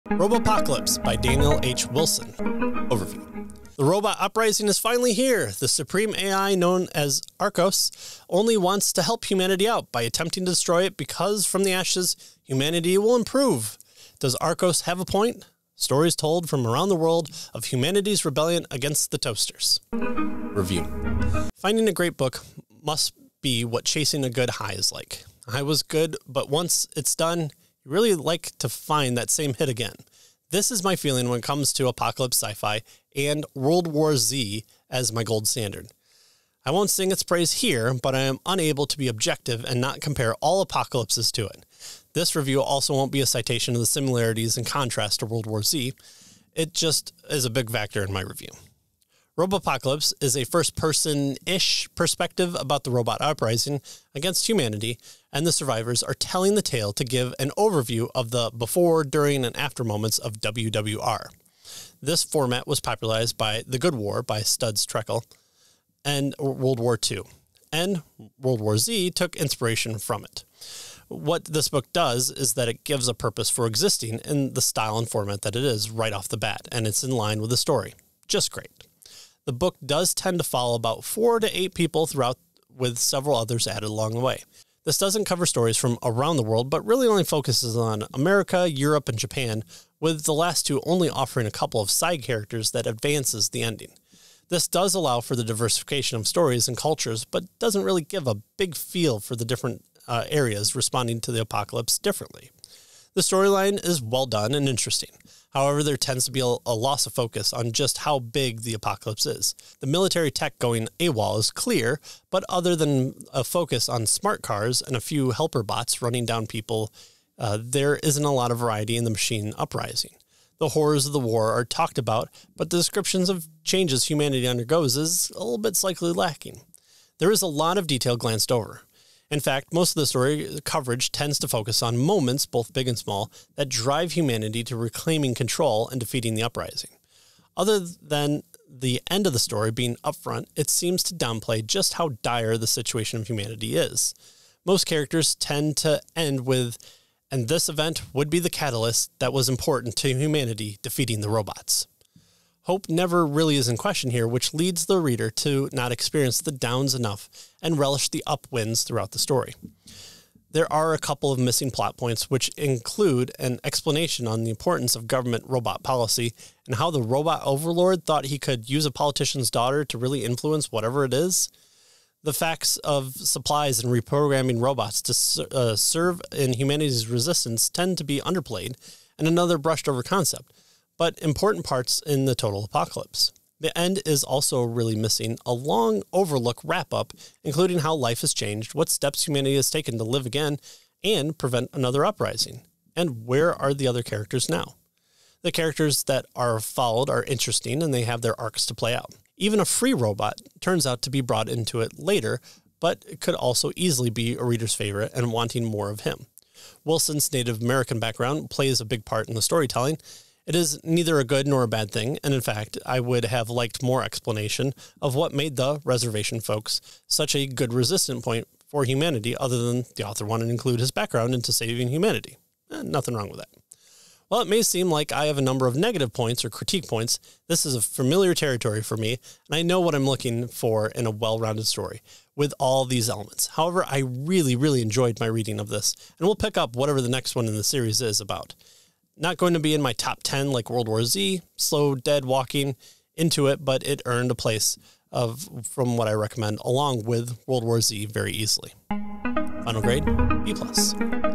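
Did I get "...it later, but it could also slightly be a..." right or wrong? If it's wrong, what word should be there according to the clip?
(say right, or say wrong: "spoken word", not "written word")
wrong: "easily", not "slightly".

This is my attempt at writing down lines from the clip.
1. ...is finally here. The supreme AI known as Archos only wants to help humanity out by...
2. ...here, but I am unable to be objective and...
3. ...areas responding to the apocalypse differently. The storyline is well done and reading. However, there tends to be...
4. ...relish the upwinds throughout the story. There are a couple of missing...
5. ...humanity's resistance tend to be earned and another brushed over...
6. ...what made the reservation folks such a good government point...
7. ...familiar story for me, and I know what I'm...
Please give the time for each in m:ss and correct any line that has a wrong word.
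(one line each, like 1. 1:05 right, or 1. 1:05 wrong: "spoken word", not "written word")
1. 0:04 right
2. 0:37 right
3. 1:40 wrong: "interesting", not "reading"
4. 2:37 right
5. 2:56 wrong: "underplayed", not "earned"
6. 3:35 wrong: "resistant", not "government"
7. 3:47 wrong: "territory", not "story".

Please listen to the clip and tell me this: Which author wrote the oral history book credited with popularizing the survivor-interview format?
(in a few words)
Studs Terkel.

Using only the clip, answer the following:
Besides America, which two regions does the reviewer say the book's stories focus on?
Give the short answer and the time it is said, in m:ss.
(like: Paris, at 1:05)
Europe and Japan, at 1:28.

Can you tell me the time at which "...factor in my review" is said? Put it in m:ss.
0:47.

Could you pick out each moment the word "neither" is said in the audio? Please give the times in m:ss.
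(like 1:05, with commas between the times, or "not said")
3:30.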